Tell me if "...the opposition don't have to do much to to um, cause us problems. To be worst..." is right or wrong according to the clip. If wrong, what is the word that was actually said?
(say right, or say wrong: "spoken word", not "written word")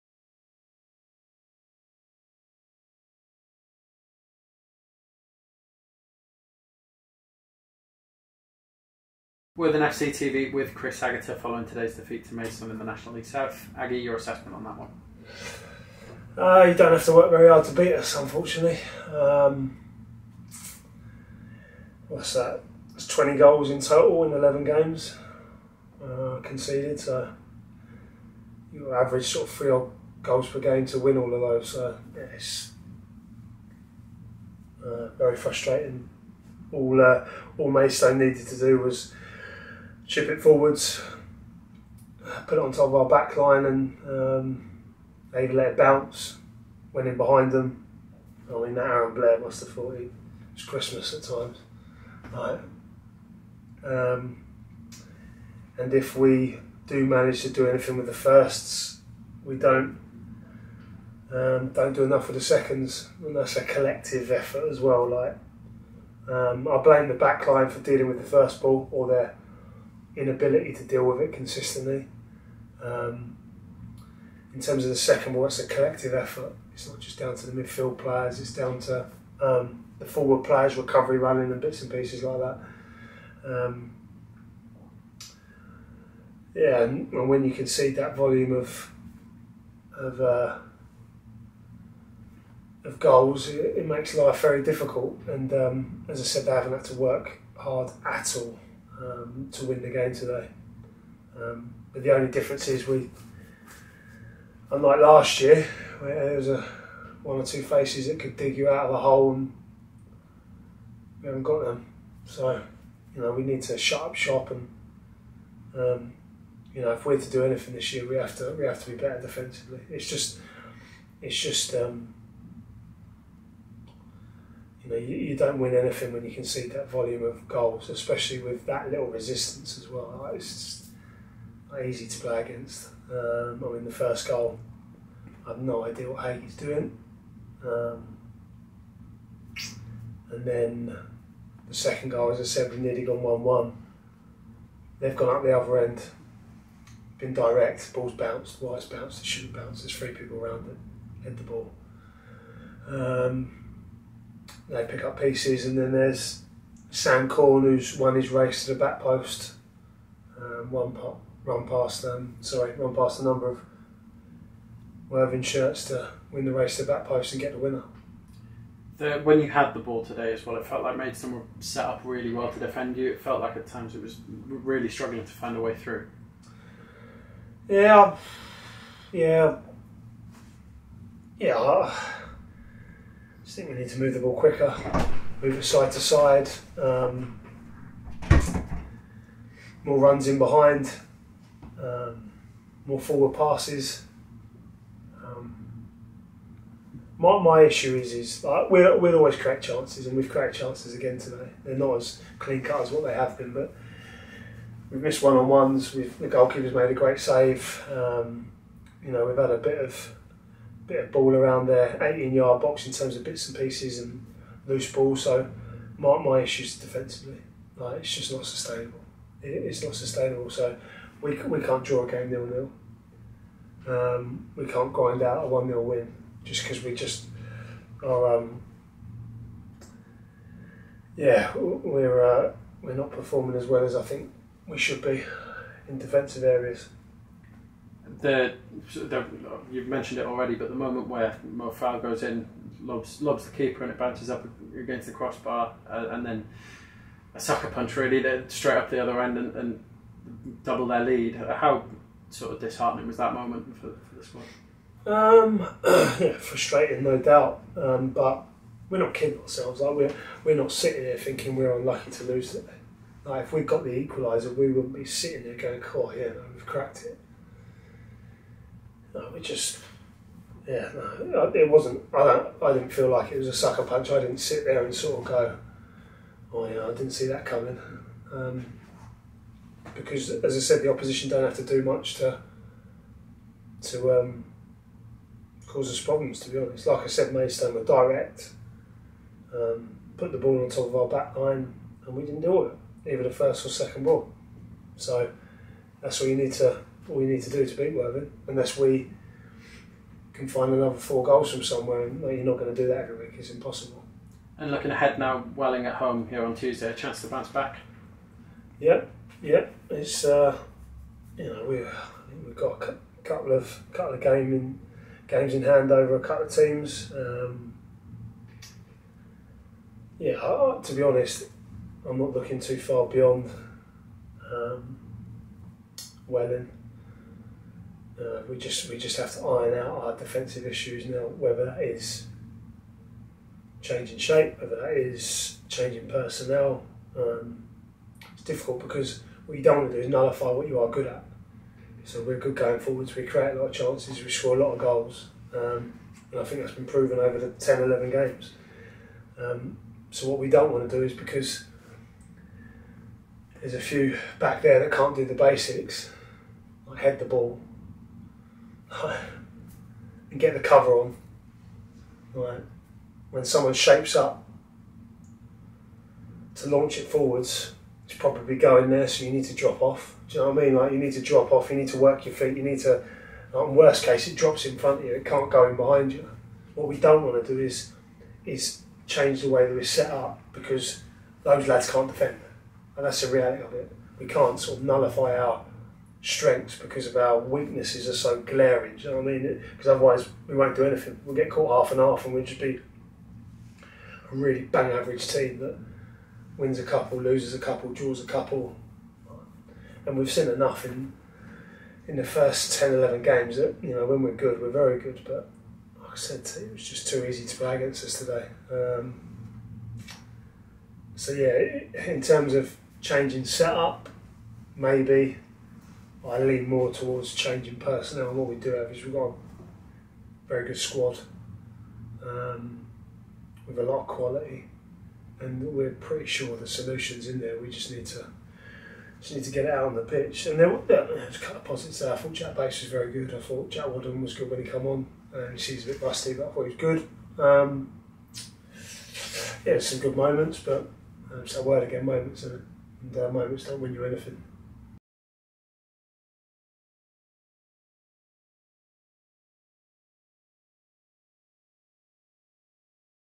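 wrong: "honest", not "worst".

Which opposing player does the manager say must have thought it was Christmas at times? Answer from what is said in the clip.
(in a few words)
Aaron Blair.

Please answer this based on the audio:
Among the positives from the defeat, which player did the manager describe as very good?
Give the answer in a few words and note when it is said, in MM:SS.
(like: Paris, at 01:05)
Jack Bates, at 07:12.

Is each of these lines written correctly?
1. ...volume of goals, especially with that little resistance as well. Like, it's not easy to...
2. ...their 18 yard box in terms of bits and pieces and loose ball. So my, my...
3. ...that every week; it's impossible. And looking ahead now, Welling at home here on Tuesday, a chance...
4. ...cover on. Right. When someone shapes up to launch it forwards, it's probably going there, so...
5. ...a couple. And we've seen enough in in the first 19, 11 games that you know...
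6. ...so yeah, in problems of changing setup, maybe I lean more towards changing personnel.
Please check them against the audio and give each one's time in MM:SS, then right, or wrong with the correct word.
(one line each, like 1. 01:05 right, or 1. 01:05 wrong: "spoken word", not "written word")
1. 02:06 right
2. 03:31 right
3. 05:02 right
4. 06:00 right
5. 06:38 wrong: "10", not "19"
6. 06:51 wrong: "terms", not "problems".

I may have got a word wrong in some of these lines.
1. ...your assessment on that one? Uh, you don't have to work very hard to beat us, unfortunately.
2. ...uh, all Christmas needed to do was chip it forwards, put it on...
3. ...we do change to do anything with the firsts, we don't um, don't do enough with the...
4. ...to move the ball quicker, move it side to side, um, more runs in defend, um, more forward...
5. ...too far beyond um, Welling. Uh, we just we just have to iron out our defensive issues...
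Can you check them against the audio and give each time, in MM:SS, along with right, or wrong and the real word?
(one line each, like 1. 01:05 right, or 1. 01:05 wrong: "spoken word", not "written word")
1. 00:13 right
2. 00:37 wrong: "Maidstone", not "Christmas"
3. 00:56 wrong: "manage", not "change"
4. 03:03 wrong: "behind", not "defend"
5. 05:22 right.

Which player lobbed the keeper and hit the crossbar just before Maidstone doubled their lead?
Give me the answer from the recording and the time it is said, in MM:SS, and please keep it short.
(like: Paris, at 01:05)
Mo Farah, at 04:01.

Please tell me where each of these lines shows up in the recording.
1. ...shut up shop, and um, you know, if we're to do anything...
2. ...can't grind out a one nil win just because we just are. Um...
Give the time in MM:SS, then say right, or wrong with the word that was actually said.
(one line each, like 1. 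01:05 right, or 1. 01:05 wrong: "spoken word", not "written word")
1. 01:53 right
2. 03:44 right.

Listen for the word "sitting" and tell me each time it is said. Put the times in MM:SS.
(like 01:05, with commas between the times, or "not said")
04:20, 04:25.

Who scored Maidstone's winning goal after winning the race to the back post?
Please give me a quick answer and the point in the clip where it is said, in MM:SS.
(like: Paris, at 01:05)
Sam Corne, at 02:36.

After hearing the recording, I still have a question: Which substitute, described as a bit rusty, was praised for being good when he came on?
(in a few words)
Jack Wadden.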